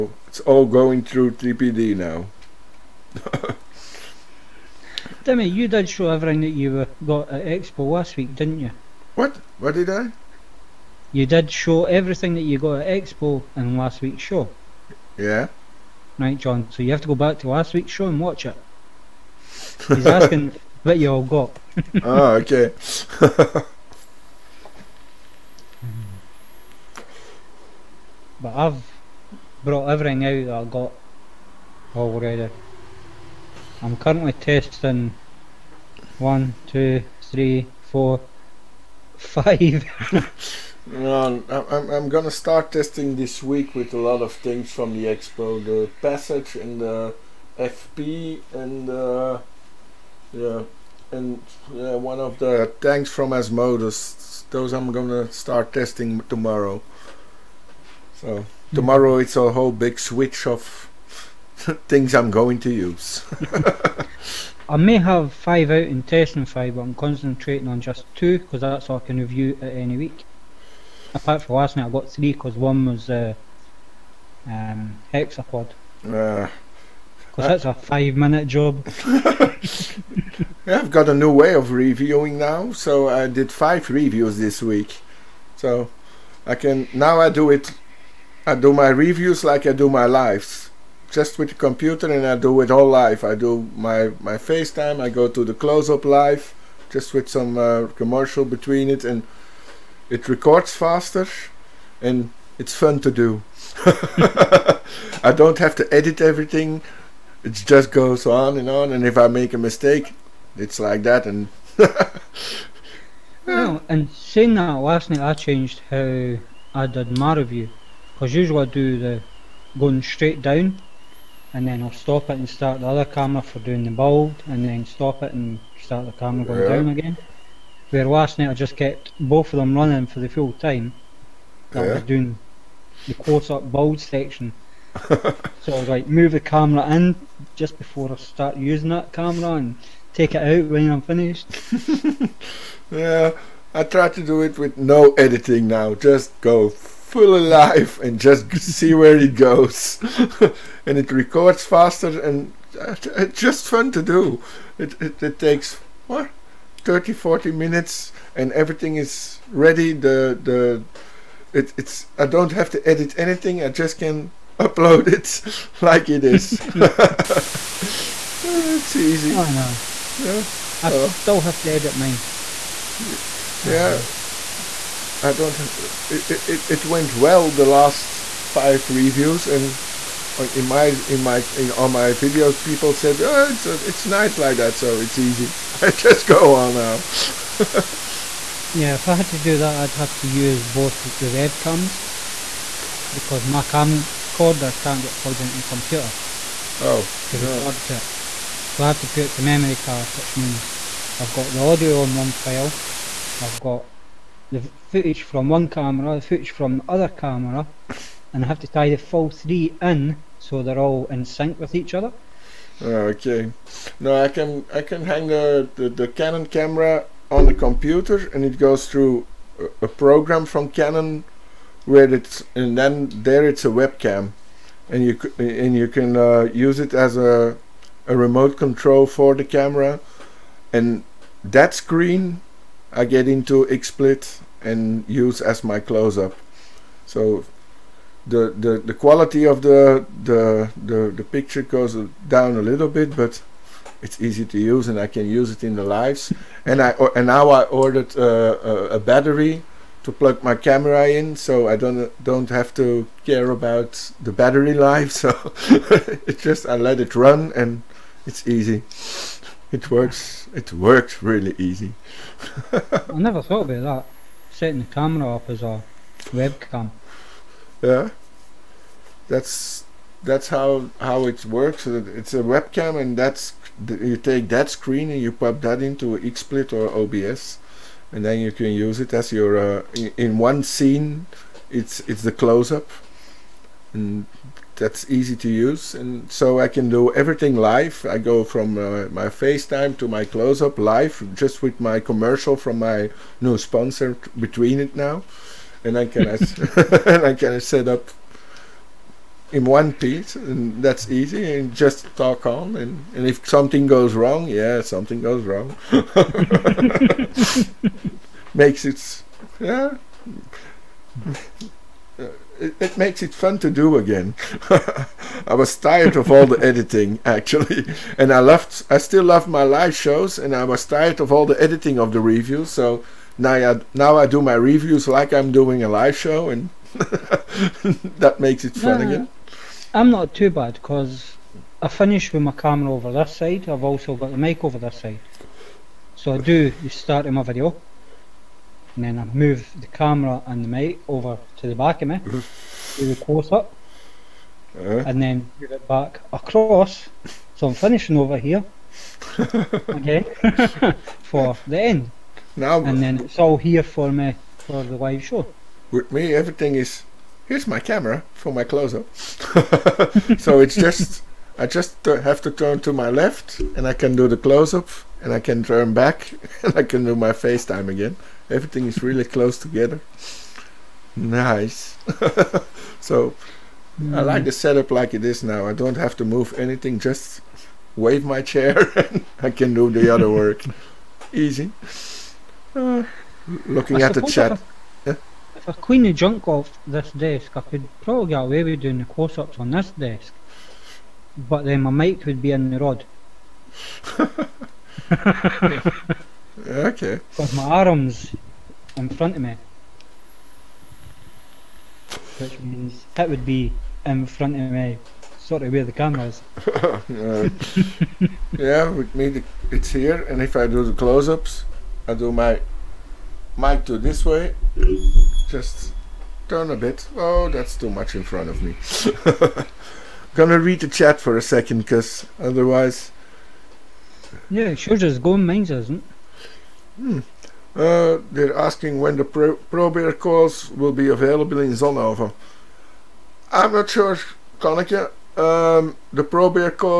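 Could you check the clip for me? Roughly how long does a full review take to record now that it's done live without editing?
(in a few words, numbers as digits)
30 to 40 minutes.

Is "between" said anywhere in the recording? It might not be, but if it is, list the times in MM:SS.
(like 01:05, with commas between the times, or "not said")
01:38, 04:54.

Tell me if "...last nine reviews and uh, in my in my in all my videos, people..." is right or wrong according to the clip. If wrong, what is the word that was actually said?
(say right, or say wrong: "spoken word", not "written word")
wrong: "five", not "nine".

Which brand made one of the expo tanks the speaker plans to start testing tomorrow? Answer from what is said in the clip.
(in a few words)
Asmodus.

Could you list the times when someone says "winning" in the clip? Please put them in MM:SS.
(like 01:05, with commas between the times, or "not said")
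not said.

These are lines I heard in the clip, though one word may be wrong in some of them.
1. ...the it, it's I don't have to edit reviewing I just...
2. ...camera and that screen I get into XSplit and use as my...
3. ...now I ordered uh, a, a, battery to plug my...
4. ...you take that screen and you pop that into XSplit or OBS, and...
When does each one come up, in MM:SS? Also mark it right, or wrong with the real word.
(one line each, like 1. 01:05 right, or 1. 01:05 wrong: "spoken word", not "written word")
1. 02:40 wrong: "anything", not "reviewing"
2. 03:49 right
3. 04:07 right
4. 04:33 right.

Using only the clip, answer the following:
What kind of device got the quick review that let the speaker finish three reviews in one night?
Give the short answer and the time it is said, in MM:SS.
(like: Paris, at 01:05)
hexapod, at 01:15.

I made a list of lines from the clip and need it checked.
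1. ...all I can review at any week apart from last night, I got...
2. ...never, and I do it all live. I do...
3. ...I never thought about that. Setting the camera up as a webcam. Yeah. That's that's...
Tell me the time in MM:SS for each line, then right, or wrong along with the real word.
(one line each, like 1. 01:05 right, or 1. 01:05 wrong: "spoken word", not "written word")
1. 01:08 right
2. 01:31 wrong: "computer", not "never"
3. 04:22 right.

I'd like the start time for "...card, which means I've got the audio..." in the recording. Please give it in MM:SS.
03:19.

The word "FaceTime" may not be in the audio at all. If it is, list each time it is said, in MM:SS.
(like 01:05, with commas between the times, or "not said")
01:34, 04:49, 06:07.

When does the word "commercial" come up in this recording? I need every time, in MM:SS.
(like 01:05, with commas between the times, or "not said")
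01:37, 04:52.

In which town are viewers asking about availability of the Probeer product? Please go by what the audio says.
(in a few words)
Zonhoven.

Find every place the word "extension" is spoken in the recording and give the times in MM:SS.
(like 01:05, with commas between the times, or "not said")
not said.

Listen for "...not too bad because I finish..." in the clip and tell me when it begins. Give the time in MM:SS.
05:30.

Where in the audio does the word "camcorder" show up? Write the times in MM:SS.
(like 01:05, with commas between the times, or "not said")
03:13.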